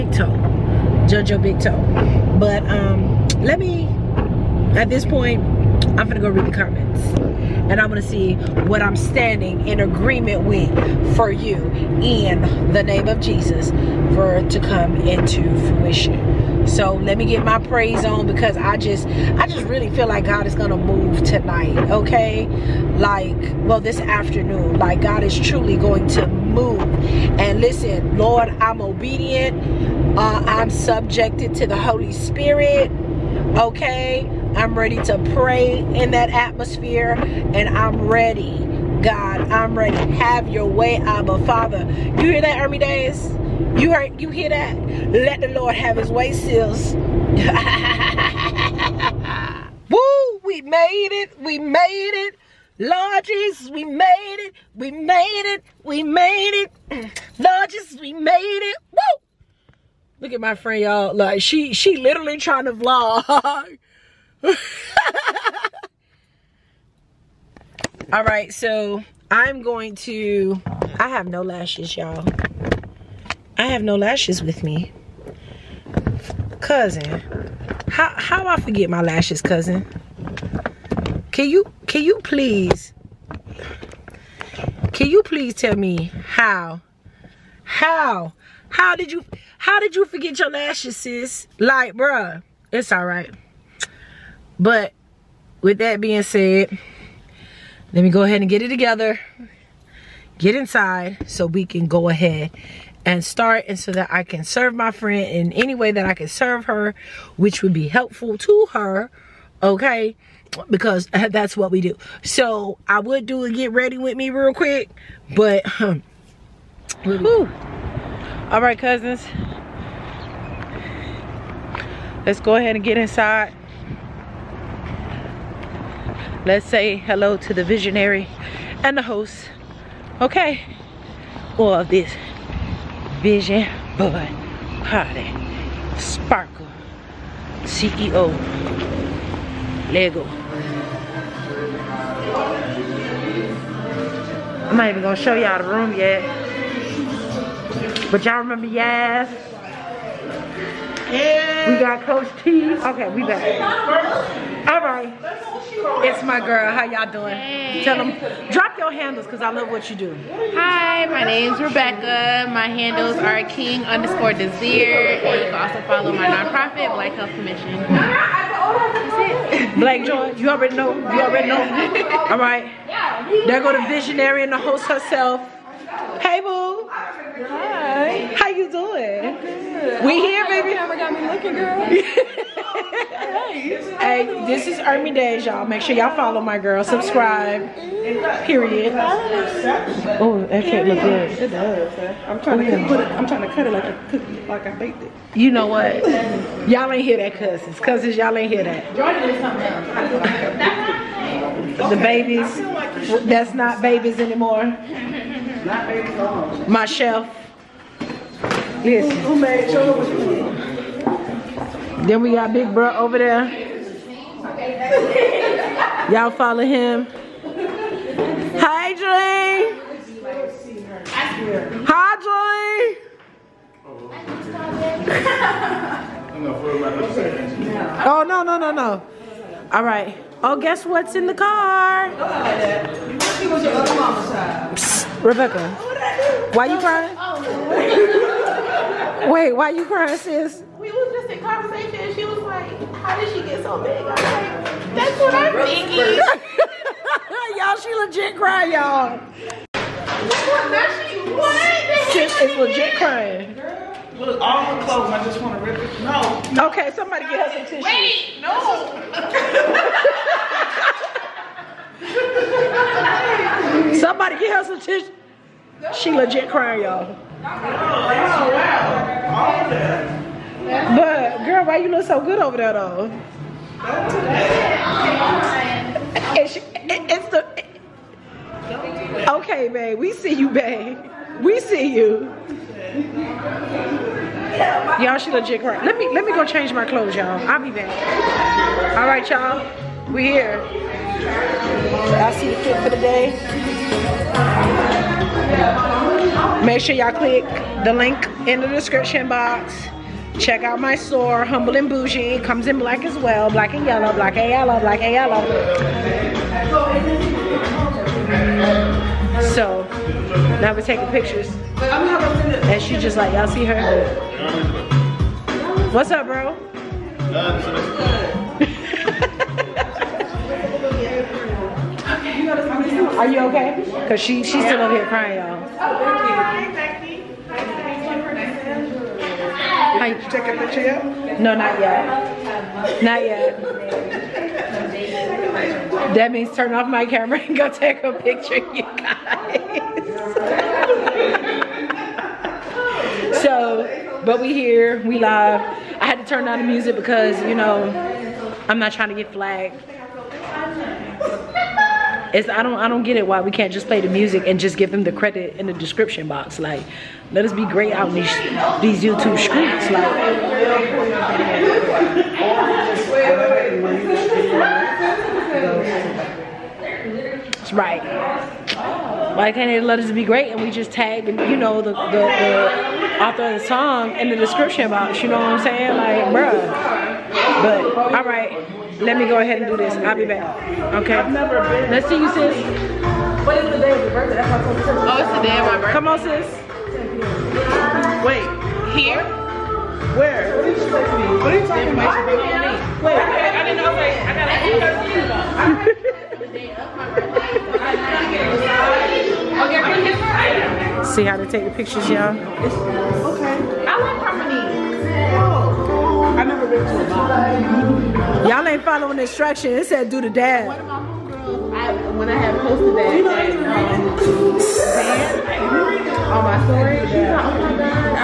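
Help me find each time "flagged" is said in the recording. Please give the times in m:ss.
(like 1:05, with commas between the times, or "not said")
5:49.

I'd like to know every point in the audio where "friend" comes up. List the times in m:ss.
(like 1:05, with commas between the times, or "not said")
1:00, 1:44.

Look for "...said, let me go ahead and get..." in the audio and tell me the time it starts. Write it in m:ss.
1:36.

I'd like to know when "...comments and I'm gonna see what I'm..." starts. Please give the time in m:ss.
0:06.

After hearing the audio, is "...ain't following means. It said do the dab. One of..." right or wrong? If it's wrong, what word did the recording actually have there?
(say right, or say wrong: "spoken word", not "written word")
wrong: "instructions", not "means".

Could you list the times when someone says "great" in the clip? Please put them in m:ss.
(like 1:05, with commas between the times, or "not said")
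5:57, 6:10.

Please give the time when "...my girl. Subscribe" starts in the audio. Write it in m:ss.
3:06.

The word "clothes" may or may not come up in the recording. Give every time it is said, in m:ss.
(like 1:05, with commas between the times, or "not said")
4:14, 4:46.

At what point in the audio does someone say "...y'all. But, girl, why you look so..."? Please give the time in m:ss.
4:26.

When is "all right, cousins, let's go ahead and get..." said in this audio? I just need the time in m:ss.
1:58.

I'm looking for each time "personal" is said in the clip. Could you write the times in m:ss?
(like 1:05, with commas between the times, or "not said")
not said.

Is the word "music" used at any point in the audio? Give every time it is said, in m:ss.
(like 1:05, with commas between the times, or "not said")
5:46, 5:54.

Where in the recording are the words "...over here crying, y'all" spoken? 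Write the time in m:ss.
5:24.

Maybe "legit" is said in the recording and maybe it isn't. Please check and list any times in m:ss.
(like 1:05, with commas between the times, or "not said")
4:08, 4:12, 4:26, 4:45.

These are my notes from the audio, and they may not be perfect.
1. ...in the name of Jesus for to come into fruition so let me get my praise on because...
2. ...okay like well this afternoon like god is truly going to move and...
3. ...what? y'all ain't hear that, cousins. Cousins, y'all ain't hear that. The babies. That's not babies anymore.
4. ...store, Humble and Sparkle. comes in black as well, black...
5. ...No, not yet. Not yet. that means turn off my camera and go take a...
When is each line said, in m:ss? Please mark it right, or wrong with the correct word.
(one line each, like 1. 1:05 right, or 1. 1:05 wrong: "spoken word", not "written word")
1. 0:12 right
2. 0:21 right
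3. 3:15 right
4. 5:00 wrong: "Bougie", not "Sparkle"
5. 5:31 right.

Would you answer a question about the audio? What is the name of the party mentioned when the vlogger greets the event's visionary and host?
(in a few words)
Vision Board Party.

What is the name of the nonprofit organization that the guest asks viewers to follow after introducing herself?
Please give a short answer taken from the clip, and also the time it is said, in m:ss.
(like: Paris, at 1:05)
Black Health Commission, at 2:46.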